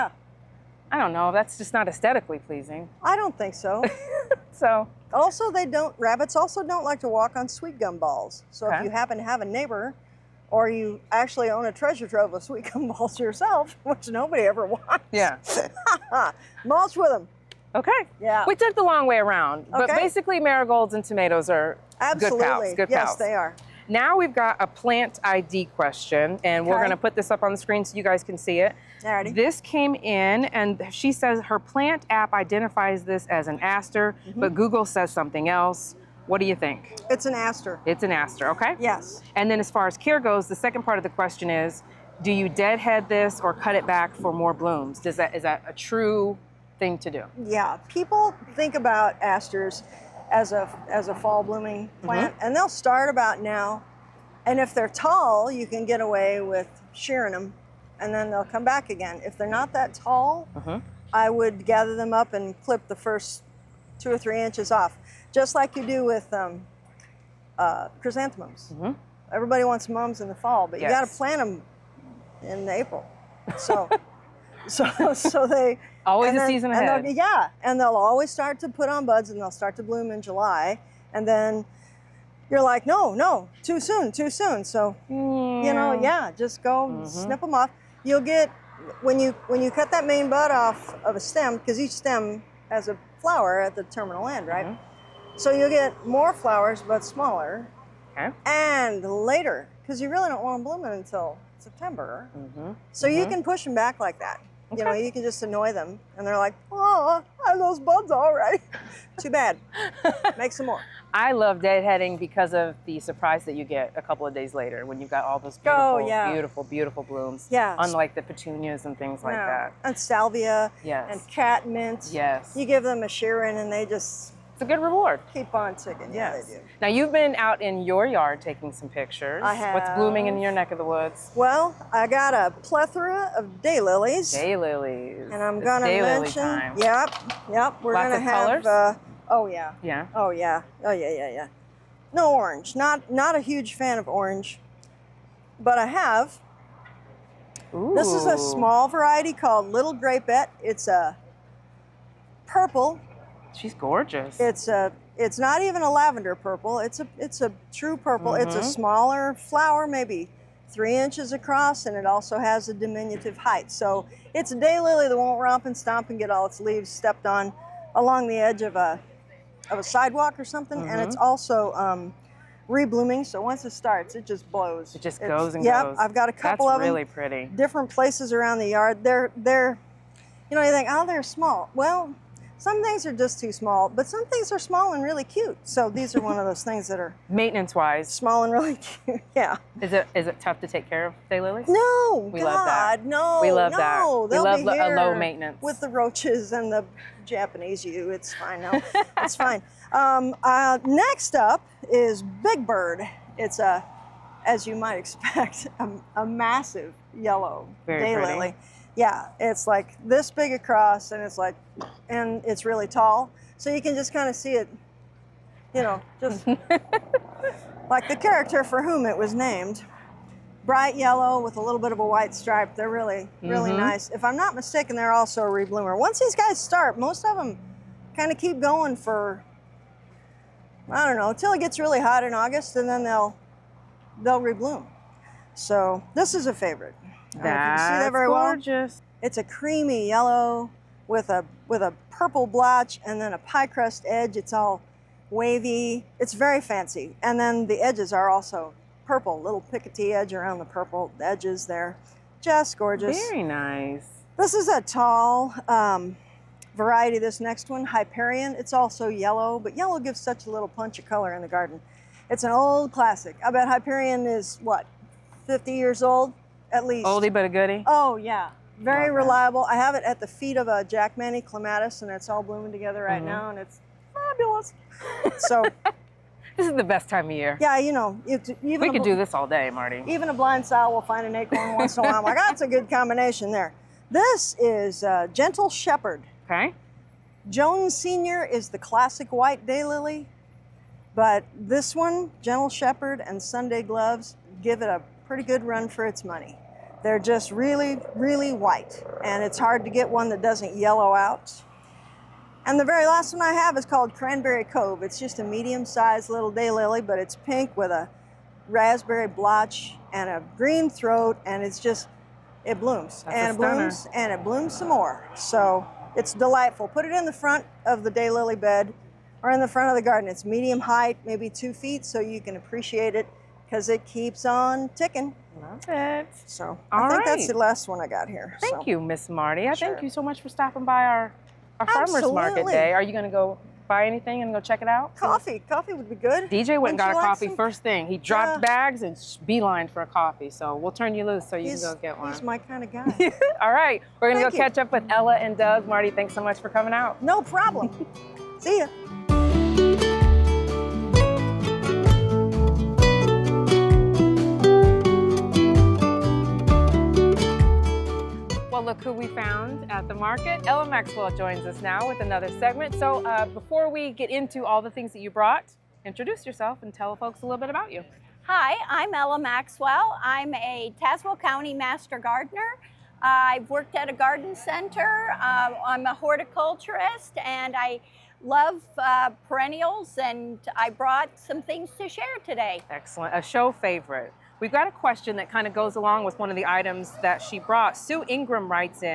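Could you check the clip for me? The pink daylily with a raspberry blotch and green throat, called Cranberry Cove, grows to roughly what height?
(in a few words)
2 feet.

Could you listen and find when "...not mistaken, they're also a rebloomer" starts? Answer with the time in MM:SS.
03:44.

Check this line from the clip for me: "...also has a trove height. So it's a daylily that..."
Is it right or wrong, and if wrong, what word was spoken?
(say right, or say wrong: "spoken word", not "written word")
wrong: "diminutive", not "trove".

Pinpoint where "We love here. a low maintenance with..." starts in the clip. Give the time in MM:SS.
03:14.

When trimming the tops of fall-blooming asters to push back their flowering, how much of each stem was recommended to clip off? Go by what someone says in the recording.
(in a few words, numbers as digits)
2 or 3 inches.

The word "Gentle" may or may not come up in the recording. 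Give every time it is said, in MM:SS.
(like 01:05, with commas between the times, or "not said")
04:45, 04:52.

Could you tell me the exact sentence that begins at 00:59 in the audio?
If they're not that tall, uh-huh.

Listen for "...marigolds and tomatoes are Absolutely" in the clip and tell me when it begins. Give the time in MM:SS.
00:20.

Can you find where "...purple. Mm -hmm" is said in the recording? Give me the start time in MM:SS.
02:37.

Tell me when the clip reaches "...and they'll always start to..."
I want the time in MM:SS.
01:17.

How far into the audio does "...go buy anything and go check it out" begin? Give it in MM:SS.
05:33.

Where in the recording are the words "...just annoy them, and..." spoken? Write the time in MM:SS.
01:45.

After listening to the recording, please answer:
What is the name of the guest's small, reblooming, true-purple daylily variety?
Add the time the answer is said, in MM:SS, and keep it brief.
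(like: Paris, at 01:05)
Little Grapette, at 02:29.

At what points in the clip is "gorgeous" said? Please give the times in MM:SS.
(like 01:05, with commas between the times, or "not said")
02:33, 03:58, 04:12.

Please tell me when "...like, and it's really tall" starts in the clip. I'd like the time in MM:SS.
03:31.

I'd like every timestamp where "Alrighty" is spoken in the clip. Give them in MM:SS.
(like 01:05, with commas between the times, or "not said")
00:29.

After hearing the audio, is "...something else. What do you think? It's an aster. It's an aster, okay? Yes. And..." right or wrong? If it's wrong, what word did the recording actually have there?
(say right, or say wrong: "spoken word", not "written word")
right.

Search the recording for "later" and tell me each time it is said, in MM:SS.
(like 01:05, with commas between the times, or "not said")
01:39, 01:54.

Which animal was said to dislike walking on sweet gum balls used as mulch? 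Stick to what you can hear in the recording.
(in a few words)
Rabbits.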